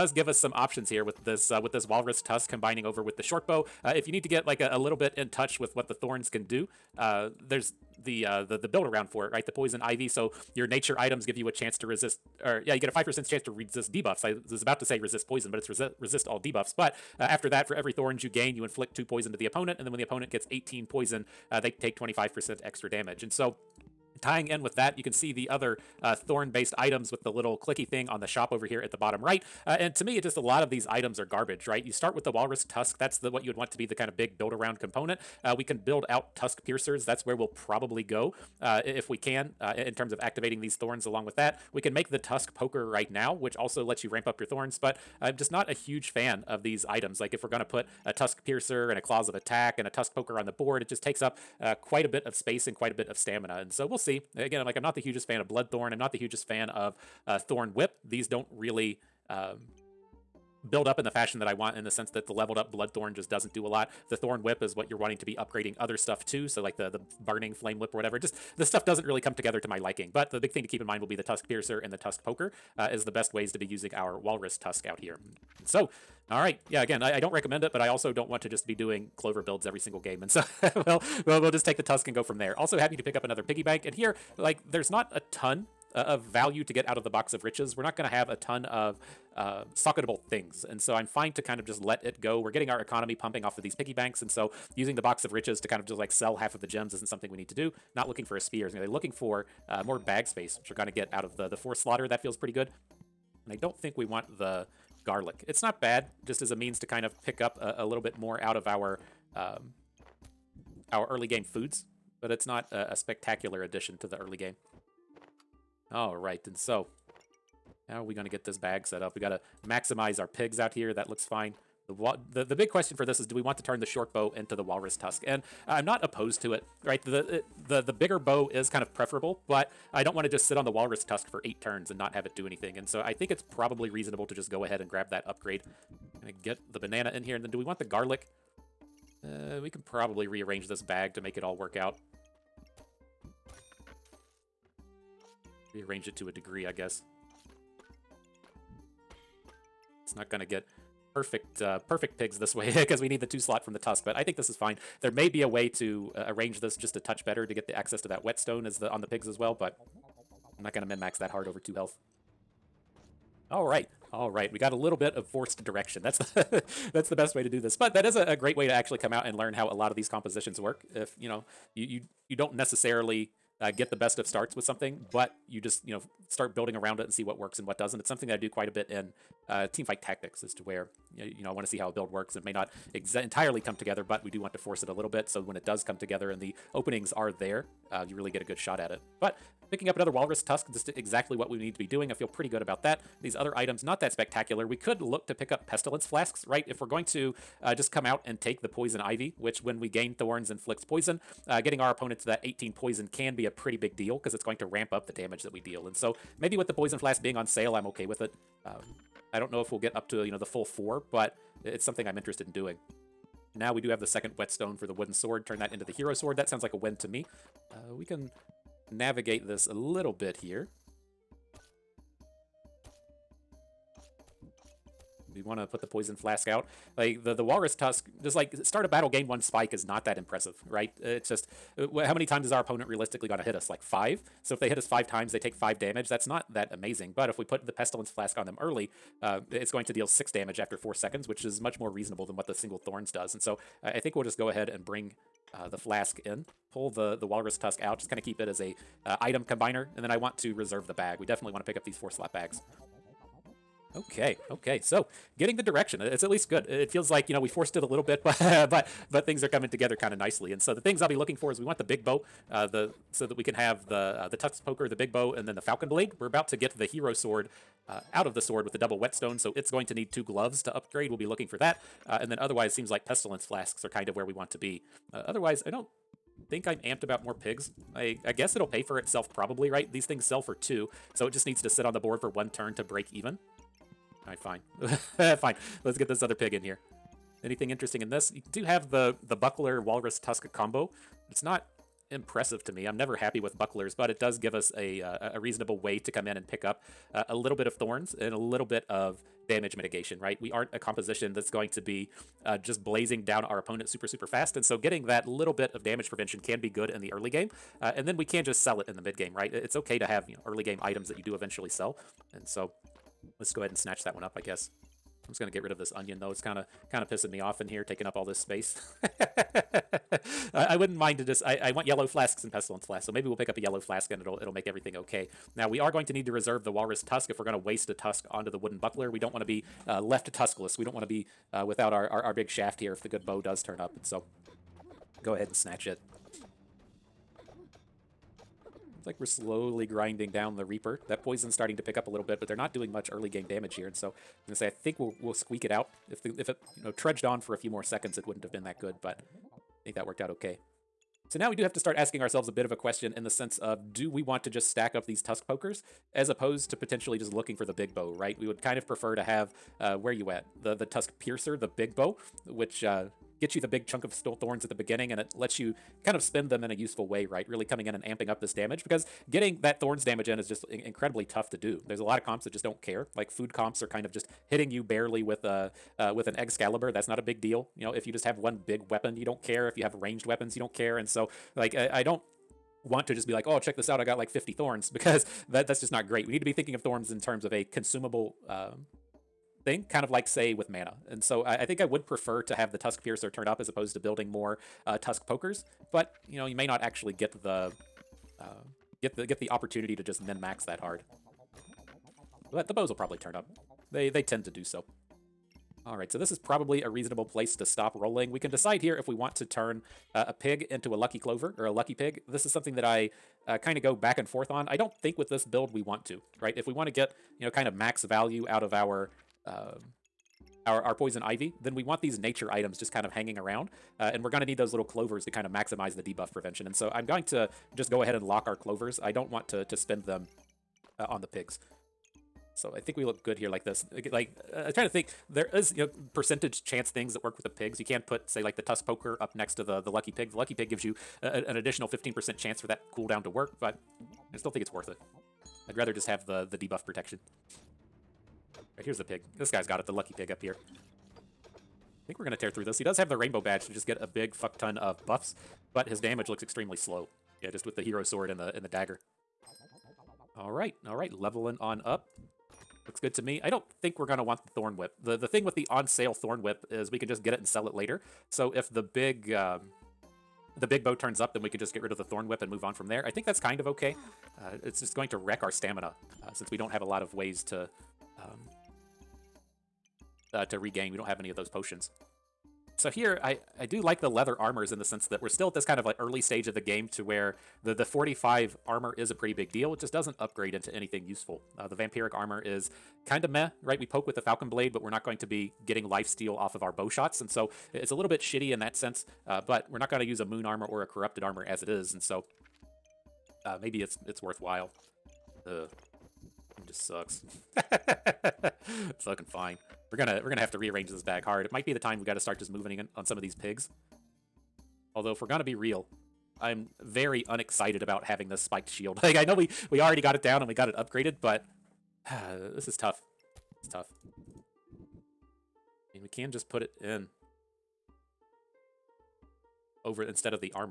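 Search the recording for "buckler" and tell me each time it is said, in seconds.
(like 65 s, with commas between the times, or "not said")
289 s, 293 s, 328 s.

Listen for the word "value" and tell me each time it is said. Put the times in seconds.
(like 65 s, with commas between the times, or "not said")
86 s, 418 s.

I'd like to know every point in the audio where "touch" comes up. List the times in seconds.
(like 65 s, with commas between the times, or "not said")
5 s, 156 s.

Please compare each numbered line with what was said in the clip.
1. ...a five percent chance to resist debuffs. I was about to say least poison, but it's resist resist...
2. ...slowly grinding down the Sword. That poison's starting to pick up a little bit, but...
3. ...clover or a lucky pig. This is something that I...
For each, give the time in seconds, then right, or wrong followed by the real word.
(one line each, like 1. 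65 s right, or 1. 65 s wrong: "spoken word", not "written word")
1. 12 s wrong: "resist", not "least"
2. 339 s wrong: "Reaper", not "Sword"
3. 411 s right.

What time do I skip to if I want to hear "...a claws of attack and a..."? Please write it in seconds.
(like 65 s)
48 s.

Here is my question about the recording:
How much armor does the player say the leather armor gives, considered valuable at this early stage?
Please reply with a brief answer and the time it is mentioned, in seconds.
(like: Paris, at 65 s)
45, at 487 s.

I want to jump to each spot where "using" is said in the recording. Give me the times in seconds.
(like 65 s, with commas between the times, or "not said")
73 s, 94 s.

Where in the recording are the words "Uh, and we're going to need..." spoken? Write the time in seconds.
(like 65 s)
423 s.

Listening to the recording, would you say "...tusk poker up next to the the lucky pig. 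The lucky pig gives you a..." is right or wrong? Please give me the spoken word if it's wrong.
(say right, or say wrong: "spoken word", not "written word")
right.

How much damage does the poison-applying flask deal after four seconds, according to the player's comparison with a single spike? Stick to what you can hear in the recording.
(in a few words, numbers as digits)
6.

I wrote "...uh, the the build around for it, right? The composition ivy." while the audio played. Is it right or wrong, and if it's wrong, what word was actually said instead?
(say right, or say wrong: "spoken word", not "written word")
wrong: "poison", not "composition".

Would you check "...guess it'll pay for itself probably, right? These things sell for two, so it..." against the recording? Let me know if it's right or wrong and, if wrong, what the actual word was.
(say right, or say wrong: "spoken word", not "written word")
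right.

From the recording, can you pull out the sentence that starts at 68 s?
Just the stuff doesn't really come together to my liking.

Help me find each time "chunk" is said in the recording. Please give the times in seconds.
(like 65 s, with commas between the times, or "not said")
363 s.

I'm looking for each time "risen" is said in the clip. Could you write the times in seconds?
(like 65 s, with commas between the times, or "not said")
not said.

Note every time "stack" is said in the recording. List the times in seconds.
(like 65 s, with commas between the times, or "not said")
354 s.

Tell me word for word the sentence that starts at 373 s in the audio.
Like food comps are kind of just hitting you barely with a uh, uh, with an Excalibur, that's not a big deal.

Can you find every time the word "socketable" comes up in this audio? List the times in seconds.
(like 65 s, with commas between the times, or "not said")
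89 s.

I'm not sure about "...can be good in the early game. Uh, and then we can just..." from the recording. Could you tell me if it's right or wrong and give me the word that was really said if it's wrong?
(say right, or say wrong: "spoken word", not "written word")
right.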